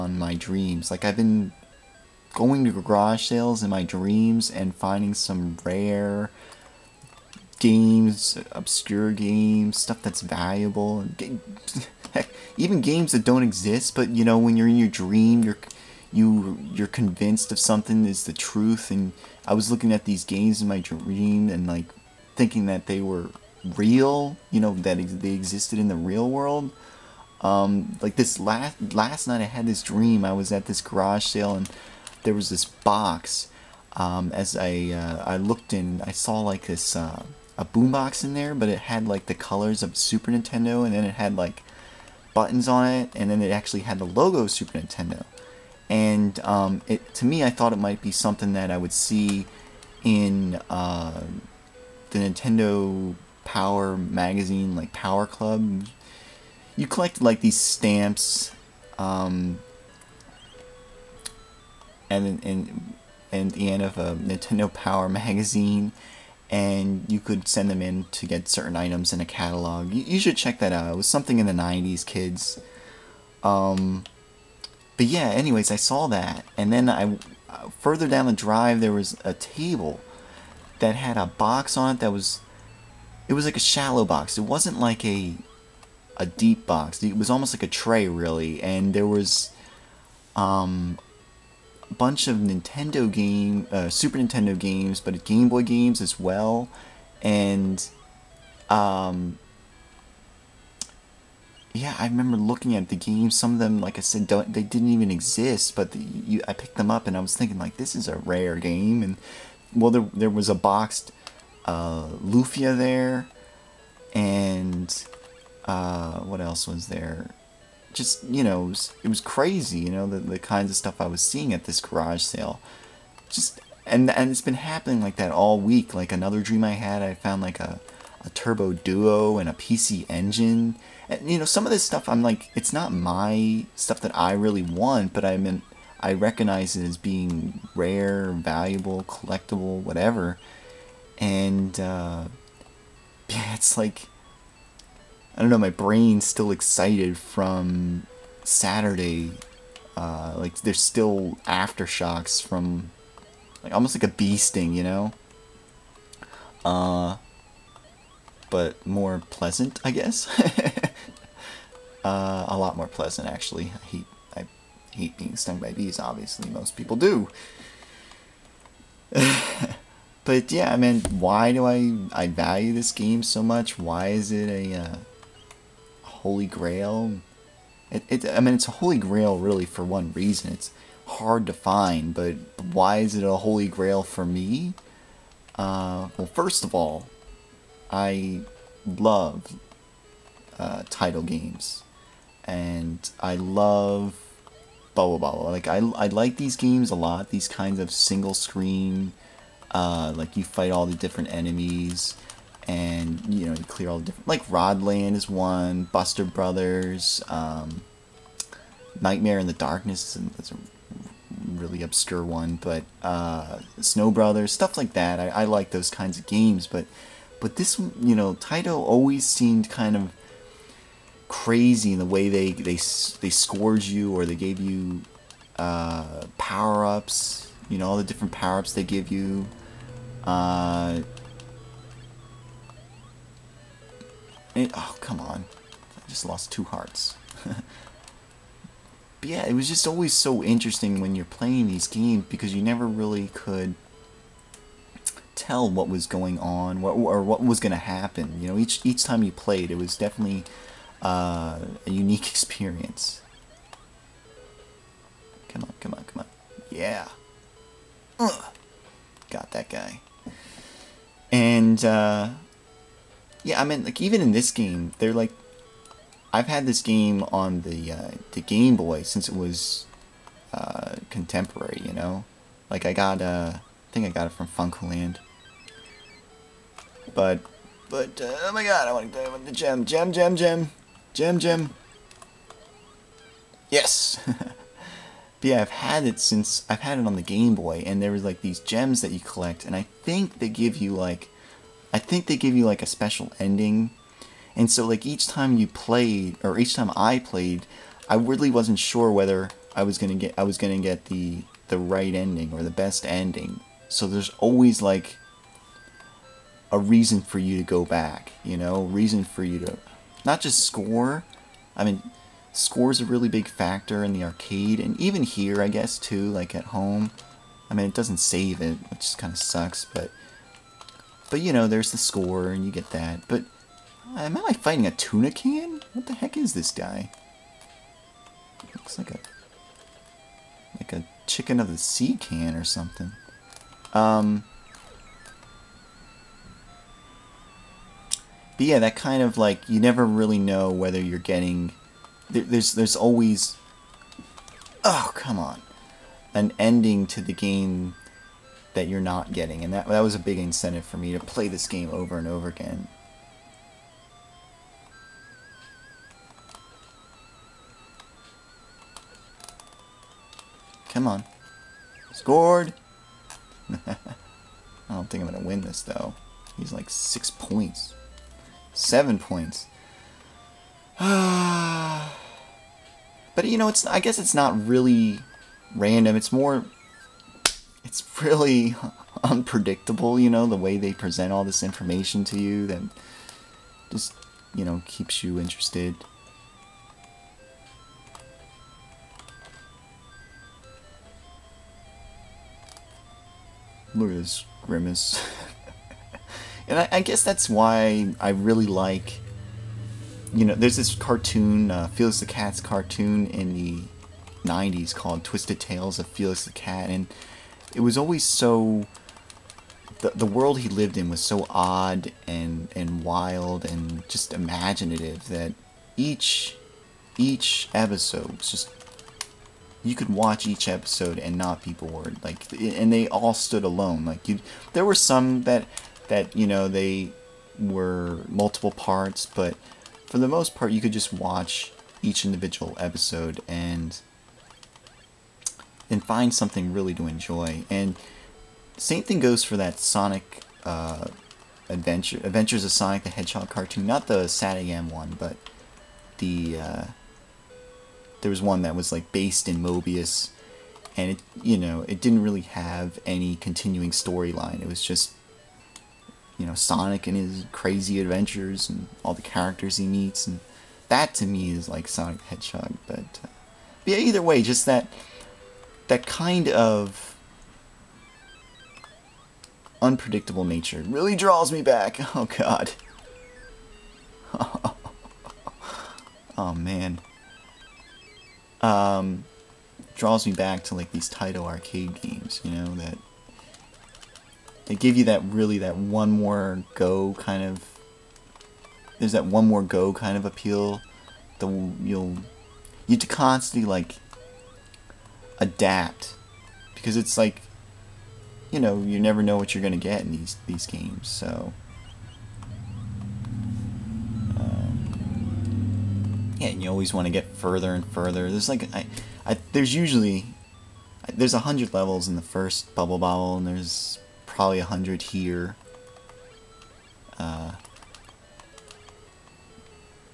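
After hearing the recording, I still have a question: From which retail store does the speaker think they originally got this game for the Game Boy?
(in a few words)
FuncoLand.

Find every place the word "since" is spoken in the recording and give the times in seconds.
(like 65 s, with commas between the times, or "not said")
269 s, 286 s.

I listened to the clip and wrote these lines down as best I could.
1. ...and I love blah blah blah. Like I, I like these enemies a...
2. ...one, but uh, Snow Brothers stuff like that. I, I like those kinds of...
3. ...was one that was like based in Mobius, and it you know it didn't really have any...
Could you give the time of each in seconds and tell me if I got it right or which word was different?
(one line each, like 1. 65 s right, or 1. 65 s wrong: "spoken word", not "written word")
1. 192 s wrong: "games", not "enemies"
2. 212 s right
3. 448 s right.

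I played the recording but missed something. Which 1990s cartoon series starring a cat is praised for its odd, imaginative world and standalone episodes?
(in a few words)
Twisted Tales of Felix the Cat.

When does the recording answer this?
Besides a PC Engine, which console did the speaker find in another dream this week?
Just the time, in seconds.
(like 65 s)
128 s.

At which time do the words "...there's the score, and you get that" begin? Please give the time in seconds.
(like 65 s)
321 s.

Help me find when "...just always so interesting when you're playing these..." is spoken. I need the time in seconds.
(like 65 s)
239 s.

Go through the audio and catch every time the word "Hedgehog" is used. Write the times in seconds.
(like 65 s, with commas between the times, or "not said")
443 s, 462 s.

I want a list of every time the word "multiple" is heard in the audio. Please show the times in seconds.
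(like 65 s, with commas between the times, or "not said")
428 s.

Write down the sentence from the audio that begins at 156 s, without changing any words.
Uh, but more pleasant, I guess.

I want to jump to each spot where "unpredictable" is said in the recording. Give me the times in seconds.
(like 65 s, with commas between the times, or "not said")
379 s, 469 s.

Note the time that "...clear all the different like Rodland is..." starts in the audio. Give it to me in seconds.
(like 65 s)
203 s.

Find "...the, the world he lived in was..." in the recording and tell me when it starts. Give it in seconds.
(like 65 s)
409 s.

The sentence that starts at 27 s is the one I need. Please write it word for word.
Um, like this last last night, I had this dream.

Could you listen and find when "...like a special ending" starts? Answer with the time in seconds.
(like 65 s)
292 s.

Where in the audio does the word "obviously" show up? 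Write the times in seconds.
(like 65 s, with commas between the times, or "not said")
165 s.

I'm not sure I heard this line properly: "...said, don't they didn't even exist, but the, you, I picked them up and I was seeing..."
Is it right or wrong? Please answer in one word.
wrong.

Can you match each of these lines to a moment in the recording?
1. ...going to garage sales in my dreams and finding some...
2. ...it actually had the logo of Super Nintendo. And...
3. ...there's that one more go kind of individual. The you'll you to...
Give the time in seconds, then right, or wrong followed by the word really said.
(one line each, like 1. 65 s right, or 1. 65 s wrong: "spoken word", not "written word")
1. 2 s right
2. 43 s right
3. 488 s wrong: "appeal", not "individual".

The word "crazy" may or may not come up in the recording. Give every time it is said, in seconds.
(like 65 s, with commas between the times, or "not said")
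119 s, 221 s, 457 s.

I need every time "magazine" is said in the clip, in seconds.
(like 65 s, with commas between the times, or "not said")
53 s, 65 s.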